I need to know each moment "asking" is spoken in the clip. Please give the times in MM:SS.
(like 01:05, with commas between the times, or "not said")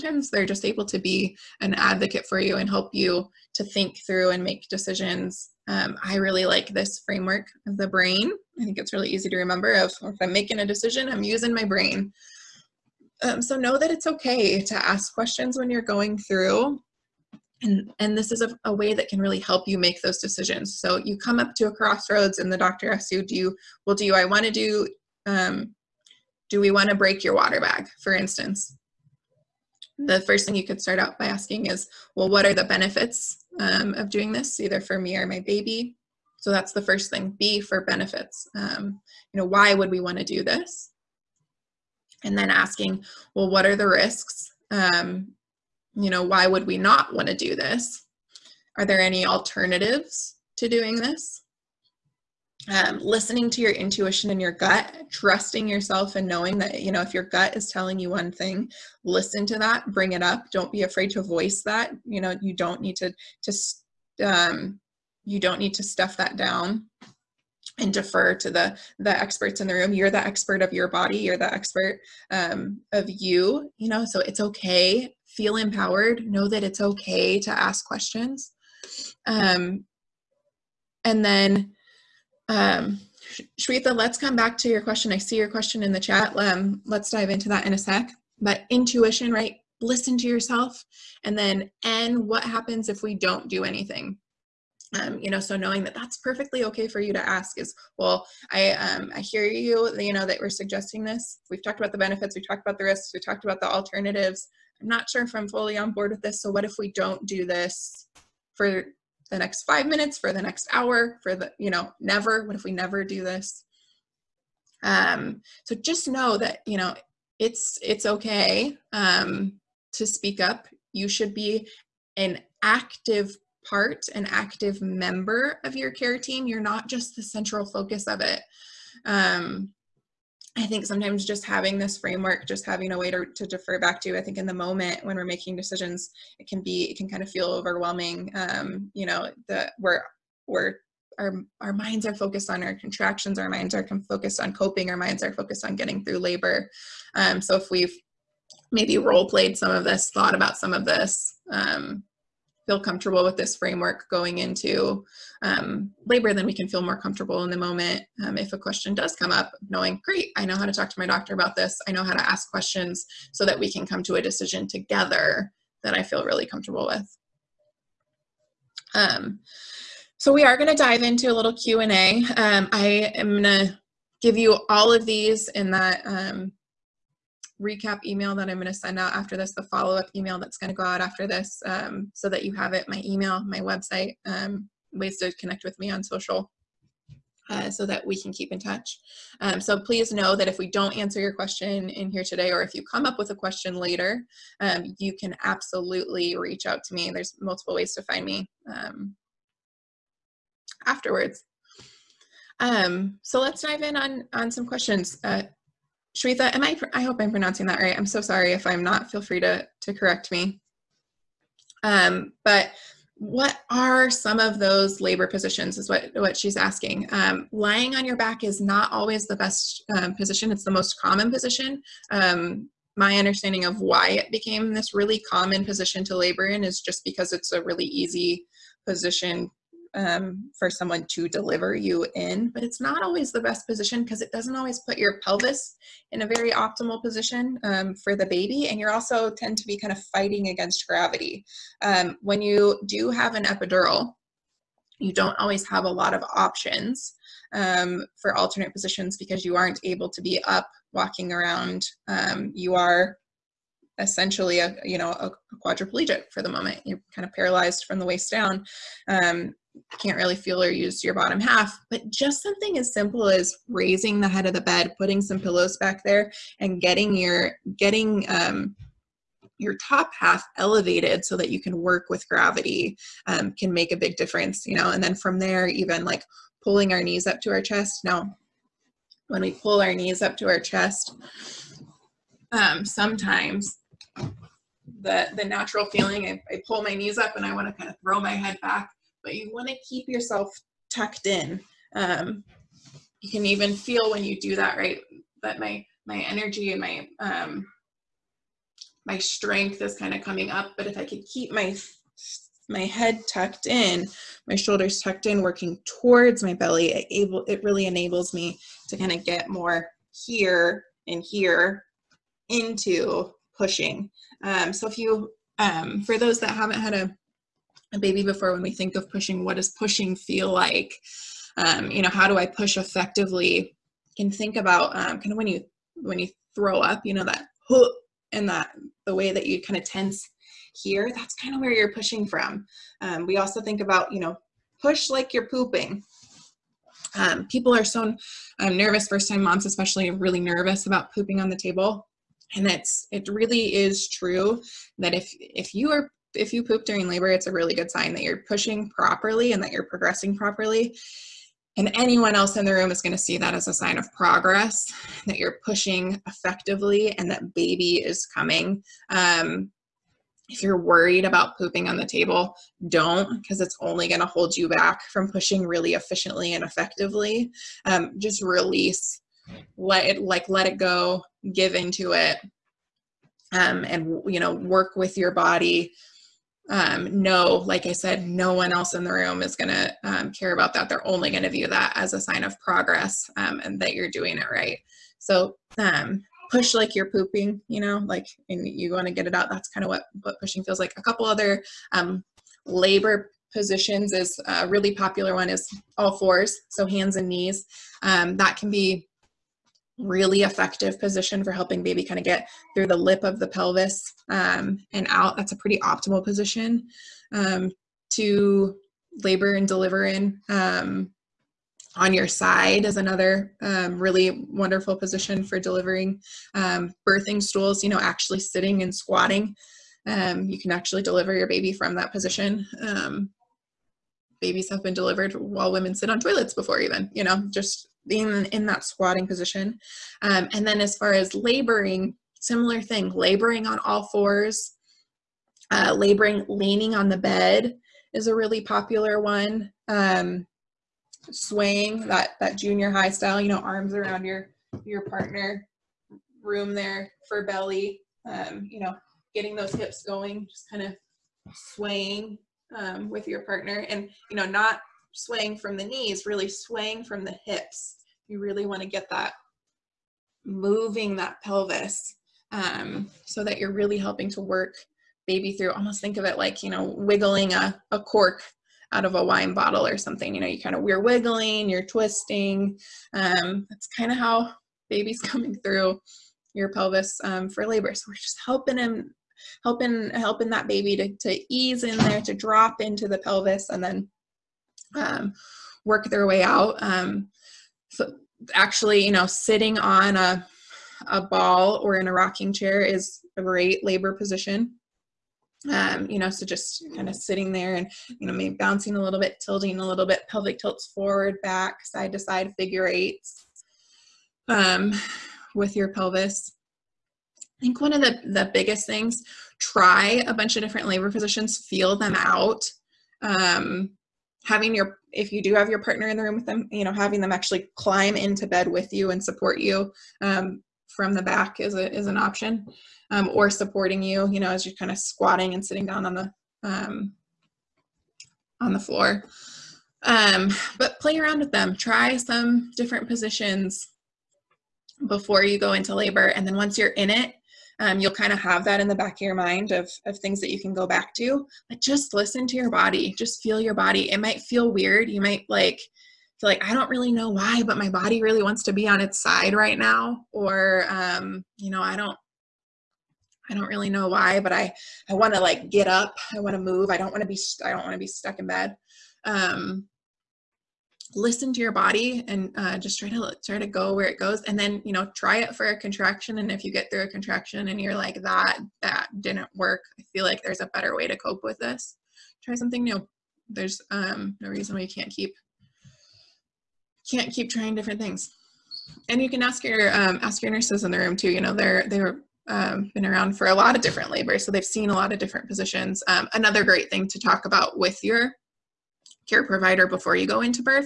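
00:31, 00:42, 03:36.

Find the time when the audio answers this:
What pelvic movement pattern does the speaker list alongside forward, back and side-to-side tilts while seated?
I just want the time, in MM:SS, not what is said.
08:22.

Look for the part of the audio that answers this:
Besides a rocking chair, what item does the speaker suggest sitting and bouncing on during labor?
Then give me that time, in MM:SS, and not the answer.
08:11.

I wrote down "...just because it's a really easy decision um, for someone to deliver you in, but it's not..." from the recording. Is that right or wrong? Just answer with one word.
wrong.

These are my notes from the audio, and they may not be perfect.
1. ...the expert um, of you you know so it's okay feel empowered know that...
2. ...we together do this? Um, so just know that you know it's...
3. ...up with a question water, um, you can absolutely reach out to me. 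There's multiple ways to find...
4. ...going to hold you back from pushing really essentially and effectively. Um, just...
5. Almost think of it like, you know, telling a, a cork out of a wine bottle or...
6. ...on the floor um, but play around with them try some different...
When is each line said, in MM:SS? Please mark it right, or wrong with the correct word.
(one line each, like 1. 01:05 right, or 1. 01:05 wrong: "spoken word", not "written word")
1. 01:11 right
2. 01:52 wrong: "never", not "together"
3. 03:13 wrong: "later", not "water"
4. 06:04 wrong: "efficiently", not "essentially"
5. 07:45 wrong: "wiggling", not "telling"
6. 08:48 right.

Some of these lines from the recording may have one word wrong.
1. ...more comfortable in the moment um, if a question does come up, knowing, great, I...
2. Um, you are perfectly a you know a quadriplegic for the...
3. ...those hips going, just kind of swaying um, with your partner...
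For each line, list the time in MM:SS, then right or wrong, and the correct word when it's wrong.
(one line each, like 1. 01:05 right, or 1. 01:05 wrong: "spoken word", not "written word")
1. 02:36 right
2. 04:12 wrong: "essentially", not "perfectly"
3. 07:29 right.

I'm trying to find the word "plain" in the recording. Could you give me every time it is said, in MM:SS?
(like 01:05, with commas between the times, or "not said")
not said.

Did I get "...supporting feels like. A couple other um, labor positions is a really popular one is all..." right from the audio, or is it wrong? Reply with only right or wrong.
wrong.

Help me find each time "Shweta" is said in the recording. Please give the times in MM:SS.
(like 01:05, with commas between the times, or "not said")
01:23, 03:26.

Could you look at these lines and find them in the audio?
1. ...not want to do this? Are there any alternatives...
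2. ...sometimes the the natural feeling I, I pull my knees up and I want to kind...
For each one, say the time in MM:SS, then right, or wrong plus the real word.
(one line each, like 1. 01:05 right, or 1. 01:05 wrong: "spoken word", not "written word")
1. 00:46 right
2. 04:42 right.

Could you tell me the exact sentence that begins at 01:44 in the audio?
I'm not sure if I'm fully on board with this.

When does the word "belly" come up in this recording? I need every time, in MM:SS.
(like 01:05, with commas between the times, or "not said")
05:06, 07:27.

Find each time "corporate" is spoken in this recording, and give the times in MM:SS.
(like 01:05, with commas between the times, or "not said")
not said.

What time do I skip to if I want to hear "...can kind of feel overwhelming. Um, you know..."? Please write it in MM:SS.
02:16.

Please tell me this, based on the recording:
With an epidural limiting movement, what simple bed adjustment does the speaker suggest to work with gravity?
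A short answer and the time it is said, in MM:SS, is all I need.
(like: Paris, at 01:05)
raising the head of the bed, at 04:23.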